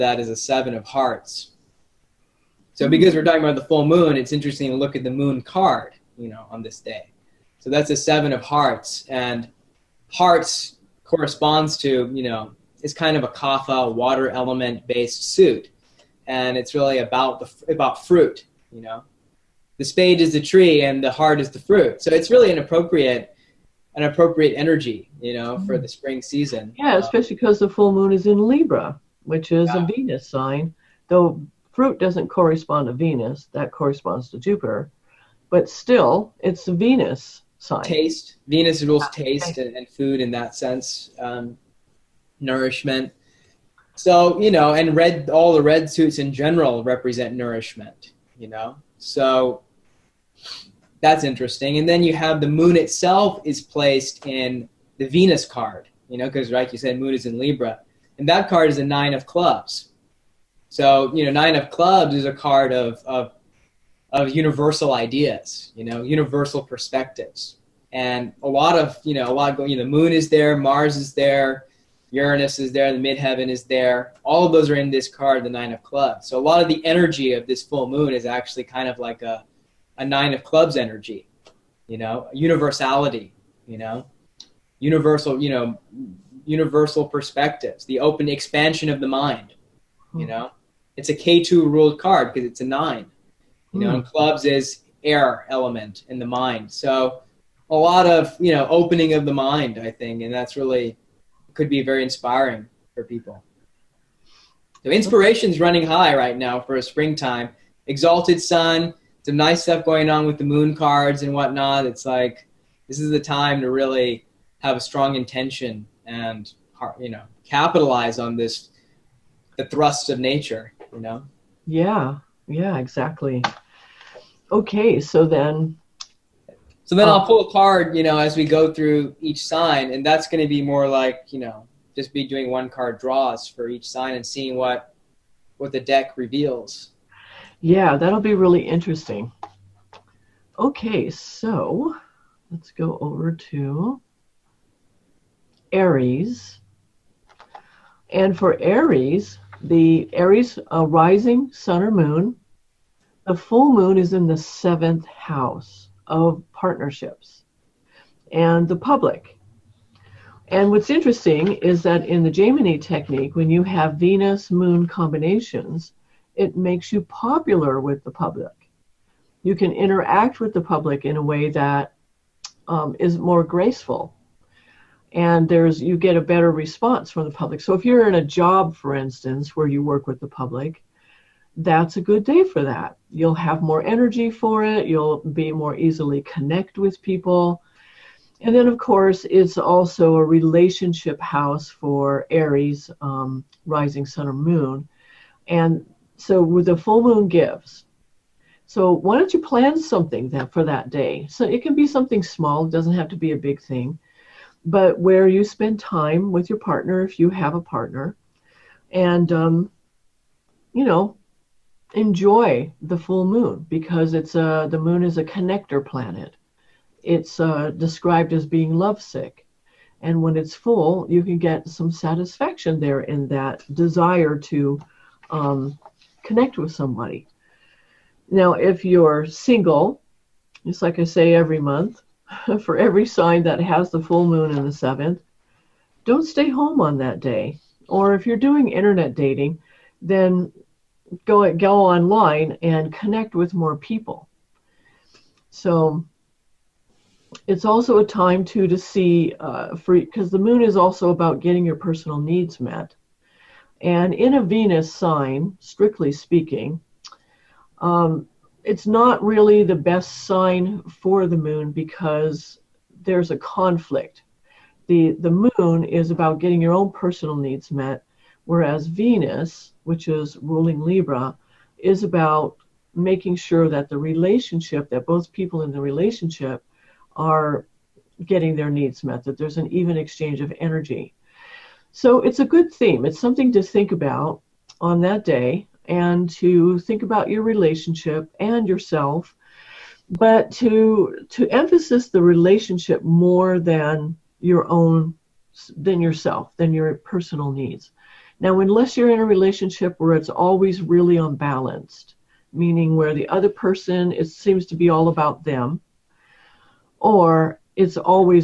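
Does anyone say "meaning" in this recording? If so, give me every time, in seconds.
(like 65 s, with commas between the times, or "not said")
302 s.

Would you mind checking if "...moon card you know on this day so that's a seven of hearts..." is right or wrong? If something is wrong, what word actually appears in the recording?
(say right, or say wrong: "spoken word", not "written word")
right.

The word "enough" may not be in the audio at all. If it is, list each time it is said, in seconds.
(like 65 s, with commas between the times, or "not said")
not said.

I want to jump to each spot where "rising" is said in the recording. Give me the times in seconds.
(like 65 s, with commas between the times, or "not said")
150 s, 193 s.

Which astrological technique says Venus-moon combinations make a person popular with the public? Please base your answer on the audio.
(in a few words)
Jaimini.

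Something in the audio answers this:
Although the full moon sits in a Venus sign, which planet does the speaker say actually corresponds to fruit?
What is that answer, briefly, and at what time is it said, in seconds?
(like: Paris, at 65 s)
Jupiter, at 34 s.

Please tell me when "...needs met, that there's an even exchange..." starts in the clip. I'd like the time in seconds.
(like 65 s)
278 s.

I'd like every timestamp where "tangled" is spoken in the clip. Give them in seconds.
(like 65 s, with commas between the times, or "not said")
not said.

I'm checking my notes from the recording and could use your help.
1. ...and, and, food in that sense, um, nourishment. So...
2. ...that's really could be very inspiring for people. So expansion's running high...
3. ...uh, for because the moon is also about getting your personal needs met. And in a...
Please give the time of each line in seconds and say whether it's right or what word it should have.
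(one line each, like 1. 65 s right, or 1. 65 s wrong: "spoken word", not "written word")
1. 39 s right
2. 100 s wrong: "inspiration", not "expansion"
3. 249 s right.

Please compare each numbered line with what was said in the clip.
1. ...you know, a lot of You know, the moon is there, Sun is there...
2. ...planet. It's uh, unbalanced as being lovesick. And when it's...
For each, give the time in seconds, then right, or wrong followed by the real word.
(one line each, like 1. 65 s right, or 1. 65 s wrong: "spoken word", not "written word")
1. 69 s wrong: "Mars", not "Sun"
2. 215 s wrong: "described", not "unbalanced".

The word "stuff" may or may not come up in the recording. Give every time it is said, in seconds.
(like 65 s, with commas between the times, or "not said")
109 s.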